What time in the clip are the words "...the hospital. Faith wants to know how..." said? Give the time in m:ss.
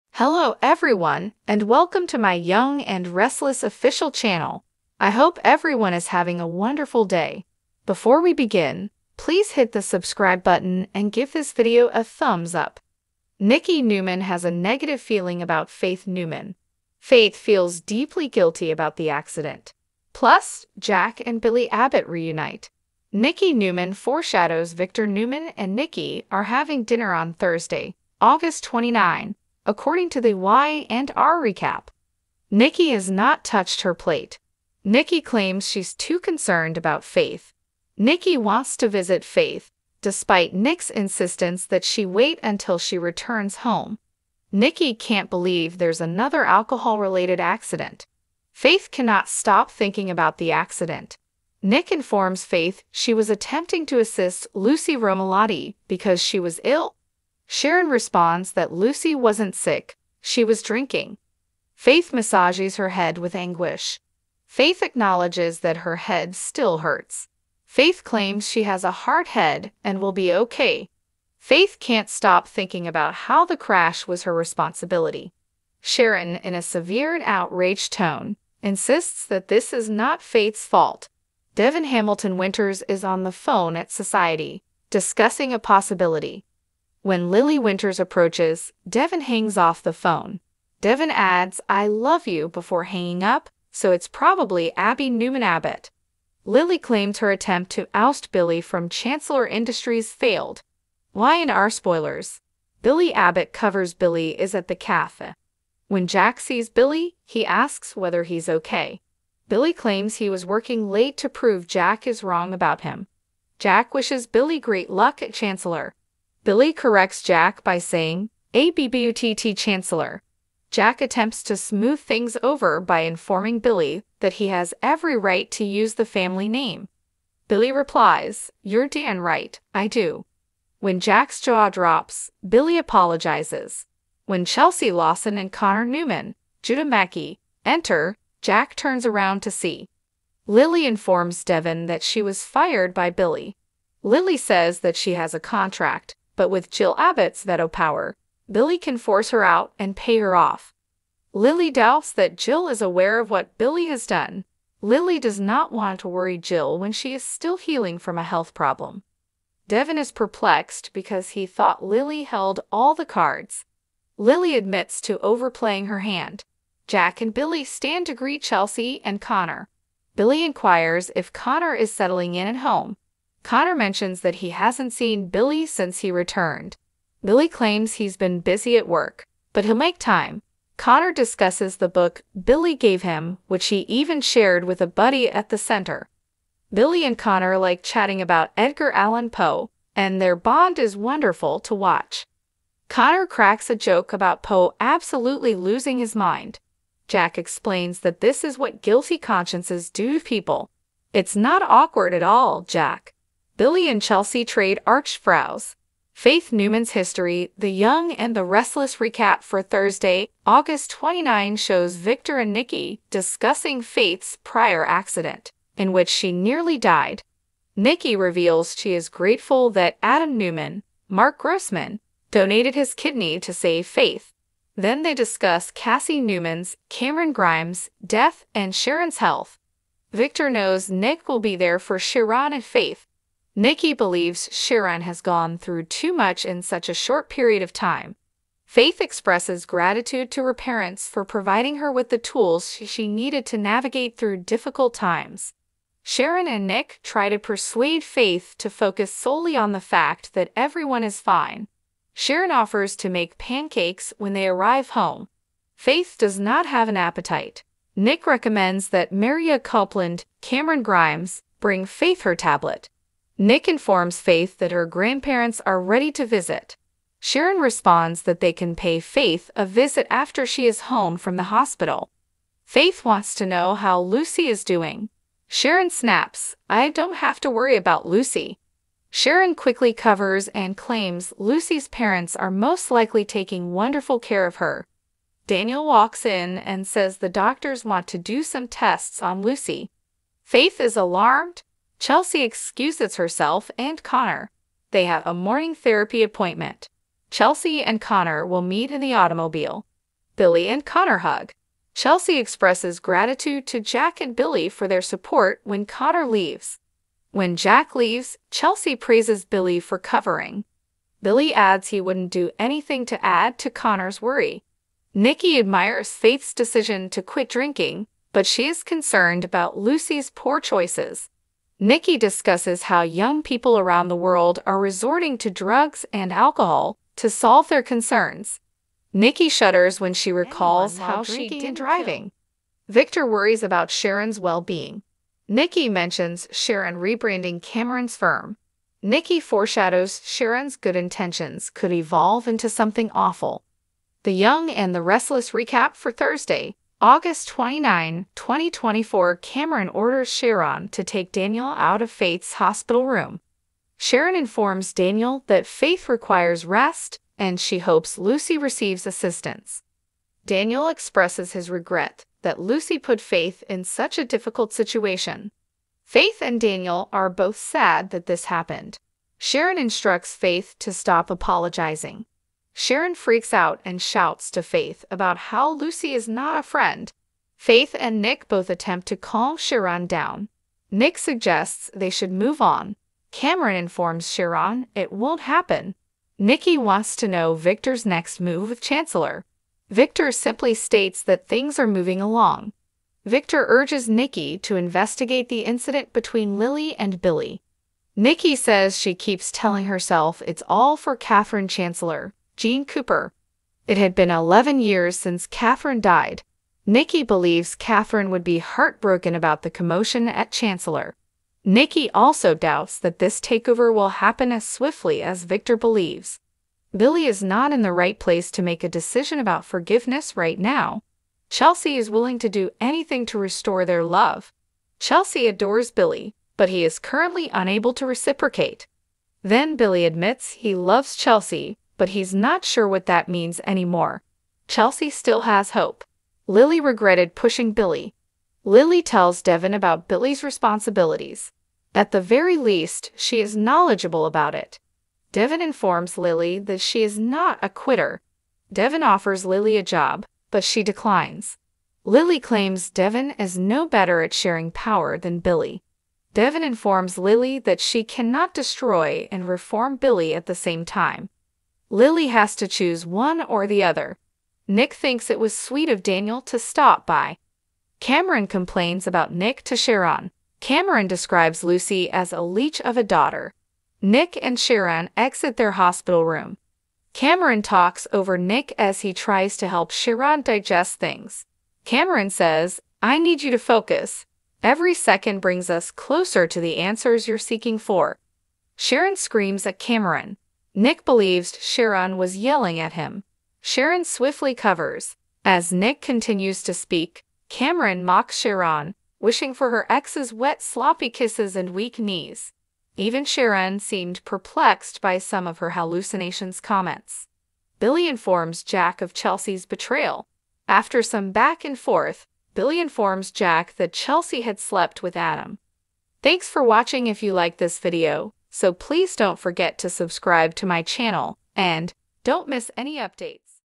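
4:31.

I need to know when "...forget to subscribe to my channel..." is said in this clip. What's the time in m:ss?
8:39.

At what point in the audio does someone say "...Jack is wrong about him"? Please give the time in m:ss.
1:51.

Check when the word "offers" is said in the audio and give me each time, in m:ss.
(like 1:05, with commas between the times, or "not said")
4:12, 7:29.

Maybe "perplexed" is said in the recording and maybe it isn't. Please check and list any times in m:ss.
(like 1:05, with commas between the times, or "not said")
2:40, 8:24.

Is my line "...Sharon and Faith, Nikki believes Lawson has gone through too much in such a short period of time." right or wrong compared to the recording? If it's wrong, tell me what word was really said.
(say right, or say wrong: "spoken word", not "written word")
wrong: "Sharon", not "Lawson".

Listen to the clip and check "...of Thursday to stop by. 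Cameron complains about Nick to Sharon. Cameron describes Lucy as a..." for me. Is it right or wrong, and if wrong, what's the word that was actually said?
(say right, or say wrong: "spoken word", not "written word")
wrong: "Daniel", not "Thursday".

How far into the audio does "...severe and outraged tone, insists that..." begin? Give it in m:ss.
1:16.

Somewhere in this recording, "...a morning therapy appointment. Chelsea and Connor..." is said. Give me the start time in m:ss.
4:55.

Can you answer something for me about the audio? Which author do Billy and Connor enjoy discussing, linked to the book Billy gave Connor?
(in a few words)
Edgar Allan Poe.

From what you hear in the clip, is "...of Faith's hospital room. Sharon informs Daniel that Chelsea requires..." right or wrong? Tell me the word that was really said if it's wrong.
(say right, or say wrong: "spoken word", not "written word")
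wrong: "Faith", not "Chelsea".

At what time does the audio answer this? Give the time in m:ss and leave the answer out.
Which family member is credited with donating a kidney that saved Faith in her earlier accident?
3:40.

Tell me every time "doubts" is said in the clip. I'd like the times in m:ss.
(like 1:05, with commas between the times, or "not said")
2:31, 6:52.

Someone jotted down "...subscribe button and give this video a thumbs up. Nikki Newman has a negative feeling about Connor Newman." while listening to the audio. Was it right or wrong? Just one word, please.
wrong.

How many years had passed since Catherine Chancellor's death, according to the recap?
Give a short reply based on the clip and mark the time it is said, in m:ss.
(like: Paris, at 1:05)
11, at 6:44.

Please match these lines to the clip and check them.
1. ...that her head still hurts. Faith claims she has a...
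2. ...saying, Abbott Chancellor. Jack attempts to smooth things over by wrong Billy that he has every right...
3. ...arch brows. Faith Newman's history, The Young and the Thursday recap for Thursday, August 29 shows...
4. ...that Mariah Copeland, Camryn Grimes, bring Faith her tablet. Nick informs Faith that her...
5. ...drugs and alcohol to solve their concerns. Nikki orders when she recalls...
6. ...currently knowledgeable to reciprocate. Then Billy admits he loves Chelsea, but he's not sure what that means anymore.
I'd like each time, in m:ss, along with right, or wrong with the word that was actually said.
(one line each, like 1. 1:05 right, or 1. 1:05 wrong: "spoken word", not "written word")
1. 1:05 right
2. 1:57 wrong: "informing", not "wrong"
3. 3:24 wrong: "Restless", not "Thursday"
4. 4:18 right
5. 5:25 wrong: "shudders", not "orders"
6. 7:06 wrong: "unable", not "knowledgeable".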